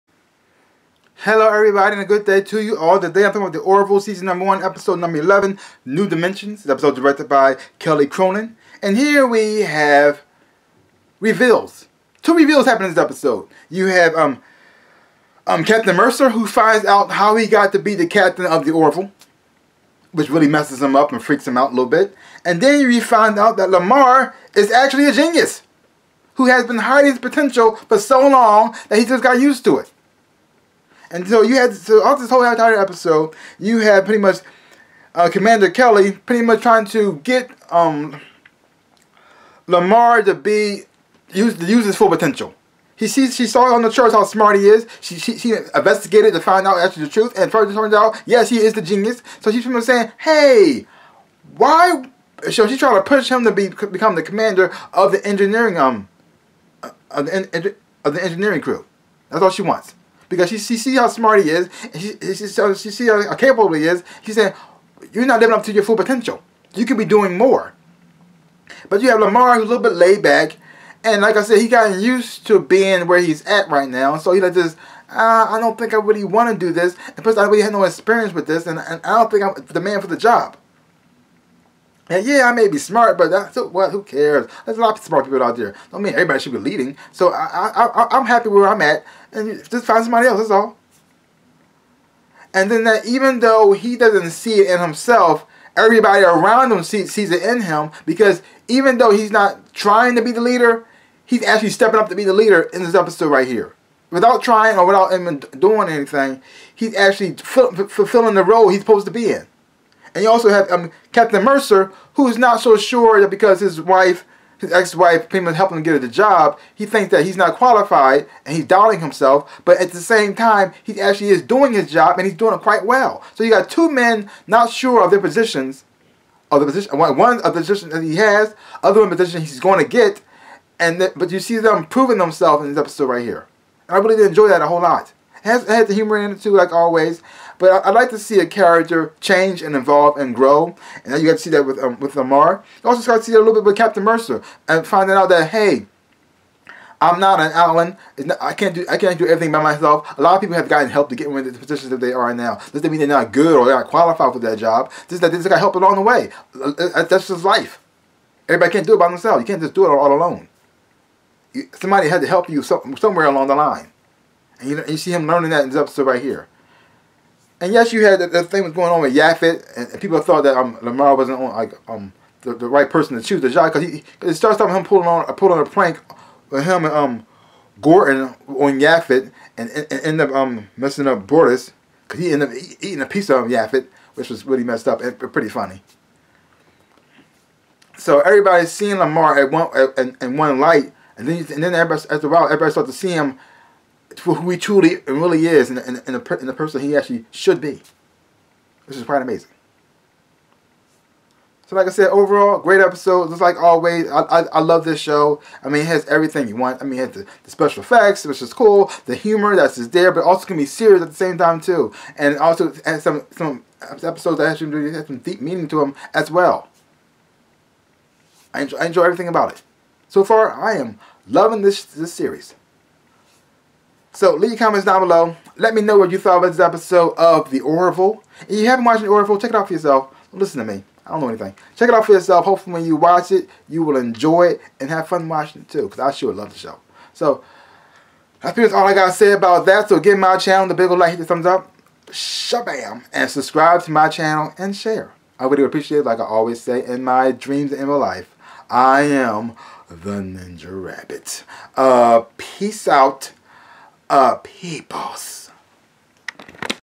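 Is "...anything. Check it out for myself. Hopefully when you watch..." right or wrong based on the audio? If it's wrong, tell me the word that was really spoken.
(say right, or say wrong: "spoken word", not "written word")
wrong: "yourself", not "myself".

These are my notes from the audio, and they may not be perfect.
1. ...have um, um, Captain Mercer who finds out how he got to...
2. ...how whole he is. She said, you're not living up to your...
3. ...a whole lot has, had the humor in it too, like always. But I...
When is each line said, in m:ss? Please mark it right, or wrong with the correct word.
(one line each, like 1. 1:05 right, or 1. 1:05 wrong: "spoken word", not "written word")
1. 0:13 right
2. 1:03 wrong: "capable", not "whole"
3. 2:14 right.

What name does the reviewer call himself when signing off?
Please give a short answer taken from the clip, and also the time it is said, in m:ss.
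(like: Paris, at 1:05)
the Ninja Rabbit, at 4:09.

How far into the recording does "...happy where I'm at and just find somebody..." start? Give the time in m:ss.
1:28.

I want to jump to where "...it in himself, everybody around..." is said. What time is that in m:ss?
1:34.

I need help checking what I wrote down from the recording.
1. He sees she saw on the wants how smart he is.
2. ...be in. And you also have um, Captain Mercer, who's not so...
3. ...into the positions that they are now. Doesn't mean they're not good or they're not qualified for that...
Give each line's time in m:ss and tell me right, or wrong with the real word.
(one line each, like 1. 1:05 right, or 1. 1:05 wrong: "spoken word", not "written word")
1. 0:42 wrong: "charts", not "wants"
2. 1:49 right
3. 2:31 right.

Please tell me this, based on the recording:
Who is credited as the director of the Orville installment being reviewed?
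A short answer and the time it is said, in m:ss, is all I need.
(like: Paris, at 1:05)
Kelly Cronin, at 0:07.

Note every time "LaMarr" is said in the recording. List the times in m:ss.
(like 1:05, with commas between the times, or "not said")
0:23, 0:39, 1:09, 2:22, 2:50, 3:08.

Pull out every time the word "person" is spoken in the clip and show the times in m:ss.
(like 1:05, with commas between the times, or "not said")
2:52, 3:16.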